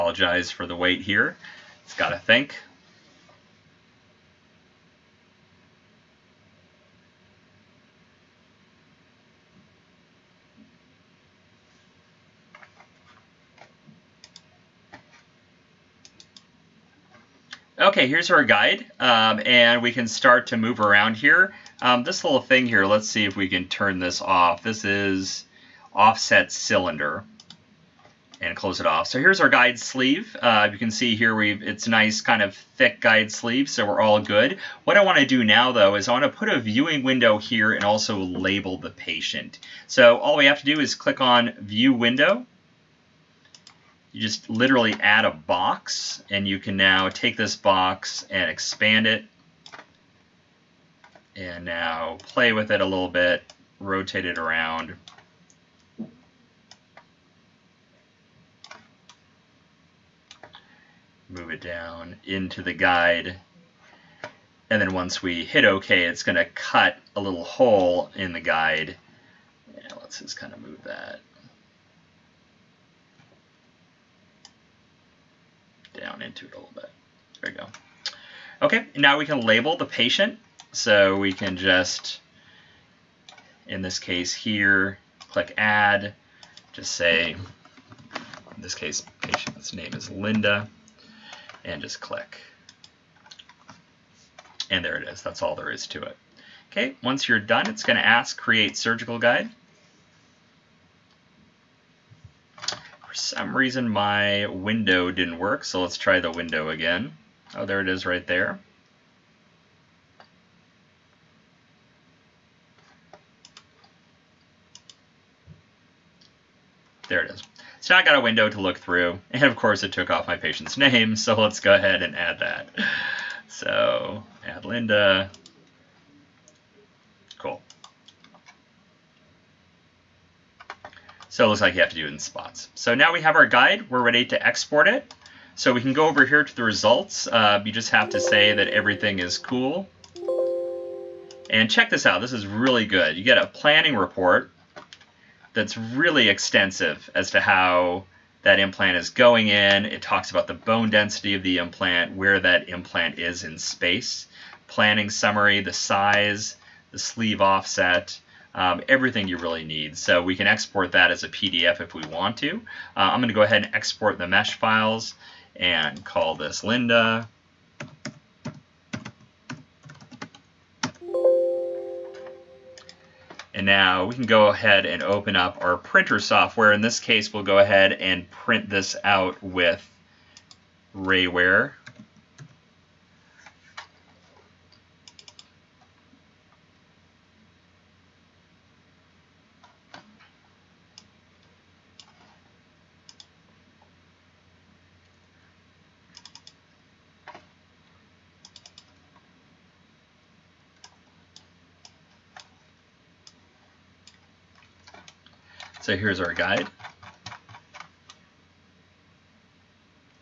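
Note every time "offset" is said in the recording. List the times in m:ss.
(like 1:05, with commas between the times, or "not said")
0:25, 2:37.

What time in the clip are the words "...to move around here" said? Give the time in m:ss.
0:20.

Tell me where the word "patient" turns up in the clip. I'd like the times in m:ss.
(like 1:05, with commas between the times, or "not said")
0:38, 1:19, 1:29, 2:00.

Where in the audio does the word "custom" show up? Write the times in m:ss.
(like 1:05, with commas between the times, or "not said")
not said.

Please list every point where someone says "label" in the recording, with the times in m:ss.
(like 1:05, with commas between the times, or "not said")
0:38, 1:19.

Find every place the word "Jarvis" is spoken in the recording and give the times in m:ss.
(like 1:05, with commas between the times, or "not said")
not said.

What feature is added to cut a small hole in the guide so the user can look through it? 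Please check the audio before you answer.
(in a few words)
View window.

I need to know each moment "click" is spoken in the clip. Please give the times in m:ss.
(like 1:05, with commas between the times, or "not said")
0:40, 1:25, 1:31.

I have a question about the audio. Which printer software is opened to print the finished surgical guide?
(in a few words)
Rayware.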